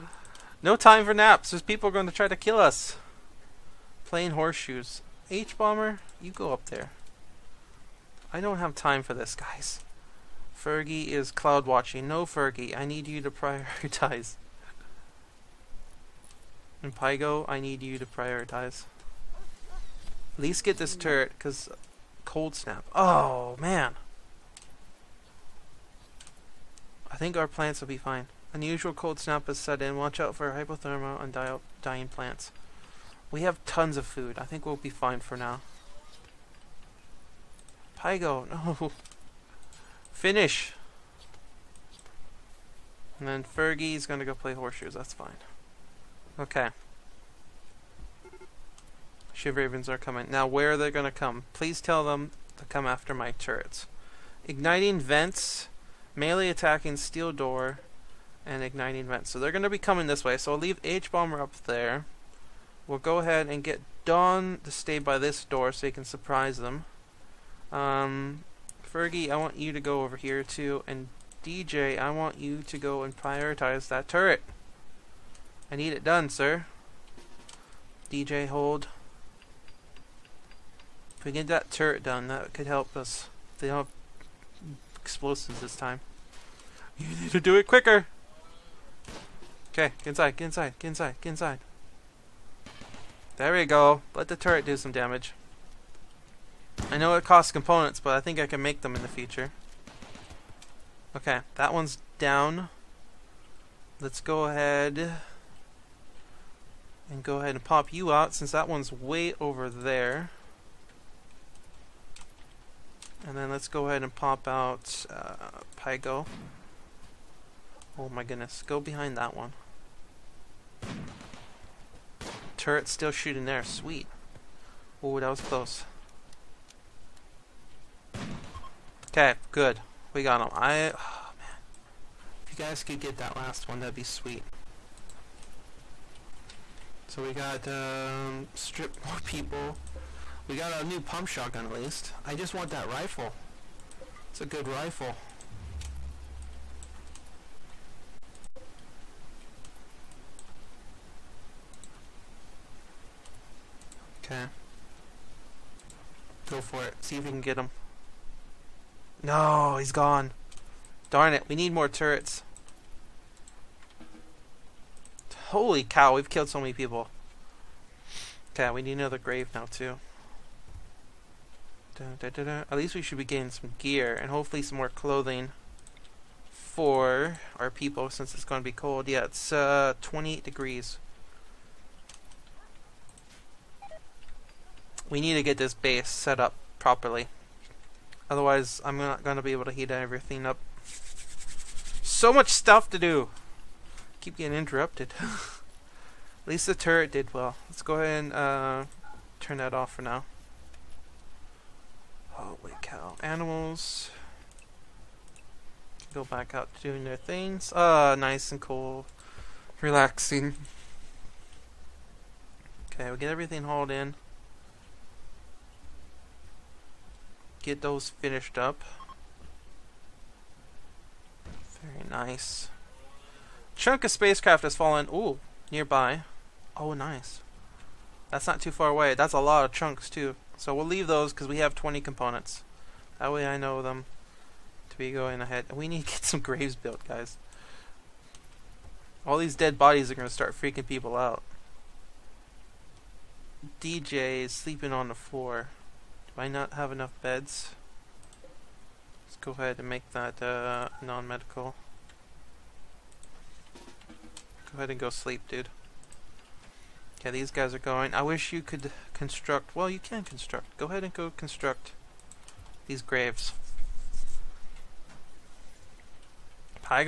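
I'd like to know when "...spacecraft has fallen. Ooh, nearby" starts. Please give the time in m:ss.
3:44.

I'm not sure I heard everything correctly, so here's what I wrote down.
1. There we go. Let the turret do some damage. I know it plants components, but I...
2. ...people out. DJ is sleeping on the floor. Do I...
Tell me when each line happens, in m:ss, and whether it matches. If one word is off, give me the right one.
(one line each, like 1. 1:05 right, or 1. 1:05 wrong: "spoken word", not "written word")
1. 1:33 wrong: "costs", not "plants"
2. 4:00 right.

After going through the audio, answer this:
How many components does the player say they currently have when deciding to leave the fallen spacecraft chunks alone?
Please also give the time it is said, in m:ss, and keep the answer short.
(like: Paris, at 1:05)
20, at 3:51.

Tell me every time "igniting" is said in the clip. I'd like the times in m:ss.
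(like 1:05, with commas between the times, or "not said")
0:54, 0:58.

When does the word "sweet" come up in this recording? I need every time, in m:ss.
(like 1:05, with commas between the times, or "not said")
2:03, 2:14.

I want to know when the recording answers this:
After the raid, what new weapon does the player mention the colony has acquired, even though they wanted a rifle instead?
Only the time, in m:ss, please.
2:20.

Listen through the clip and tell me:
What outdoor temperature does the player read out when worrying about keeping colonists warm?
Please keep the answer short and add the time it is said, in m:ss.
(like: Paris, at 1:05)
28 degrees, at 3:00.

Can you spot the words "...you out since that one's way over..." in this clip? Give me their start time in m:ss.
1:47.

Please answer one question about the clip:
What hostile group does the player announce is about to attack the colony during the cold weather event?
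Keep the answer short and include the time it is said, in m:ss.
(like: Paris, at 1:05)
Shiv Ravens, at 0:49.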